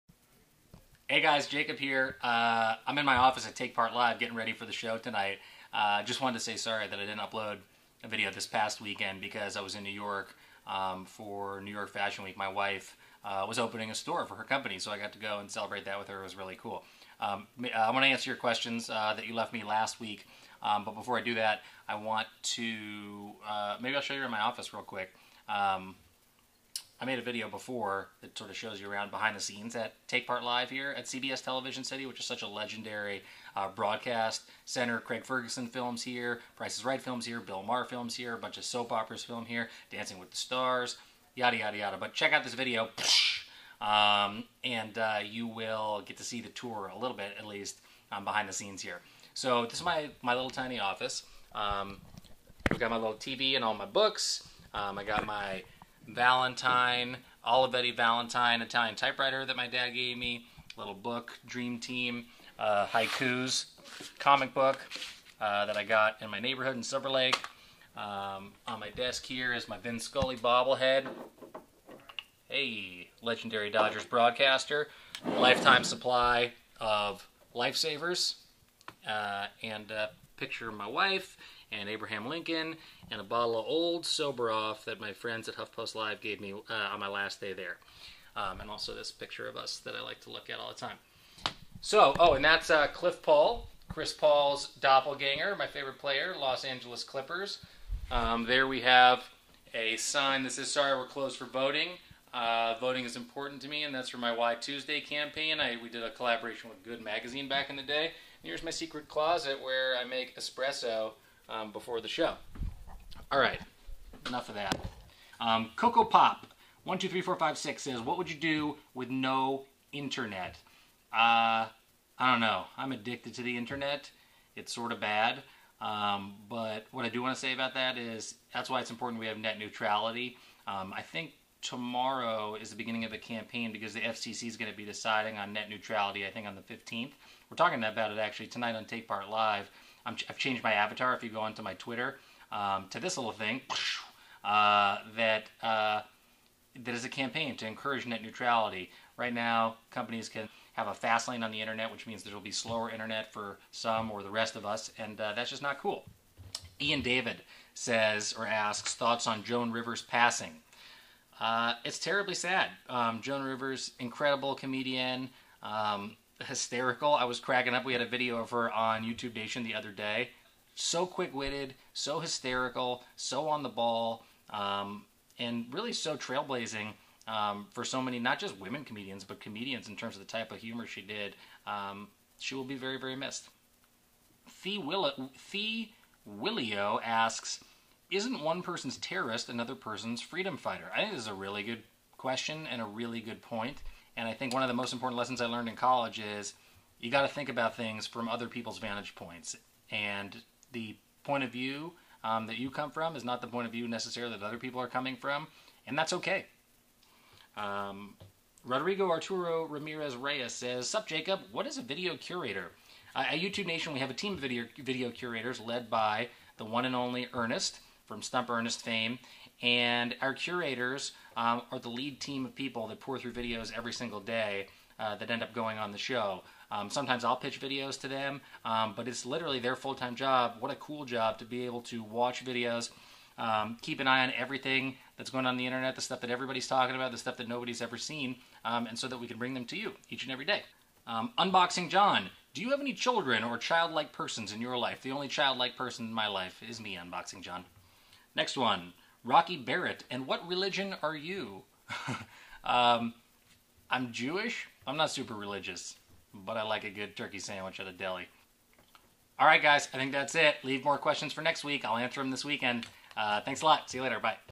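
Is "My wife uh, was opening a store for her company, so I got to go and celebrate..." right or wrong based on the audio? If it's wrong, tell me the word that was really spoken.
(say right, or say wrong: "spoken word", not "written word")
right.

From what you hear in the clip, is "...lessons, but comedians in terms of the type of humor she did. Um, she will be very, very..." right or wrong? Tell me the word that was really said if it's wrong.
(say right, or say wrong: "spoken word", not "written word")
wrong: "comedians", not "lessons".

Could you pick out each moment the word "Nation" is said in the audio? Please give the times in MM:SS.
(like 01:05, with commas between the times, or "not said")
02:49, 03:33.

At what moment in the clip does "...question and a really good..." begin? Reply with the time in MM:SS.
03:12.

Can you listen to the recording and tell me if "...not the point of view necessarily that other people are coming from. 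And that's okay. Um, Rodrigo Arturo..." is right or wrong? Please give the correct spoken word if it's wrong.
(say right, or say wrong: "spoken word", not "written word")
right.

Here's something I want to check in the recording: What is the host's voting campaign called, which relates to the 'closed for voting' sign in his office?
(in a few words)
Why Tuesday.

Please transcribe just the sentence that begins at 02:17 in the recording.
We're talking about it actually tonight on TakePart Live i have changed my avatar.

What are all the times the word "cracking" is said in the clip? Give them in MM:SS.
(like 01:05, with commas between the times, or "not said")
02:47.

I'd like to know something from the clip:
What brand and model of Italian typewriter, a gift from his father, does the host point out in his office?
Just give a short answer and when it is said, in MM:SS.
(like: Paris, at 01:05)
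Olivetti Valentine, at 00:57.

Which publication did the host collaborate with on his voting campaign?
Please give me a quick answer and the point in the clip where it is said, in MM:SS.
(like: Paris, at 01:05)
Good Magazine, at 01:46.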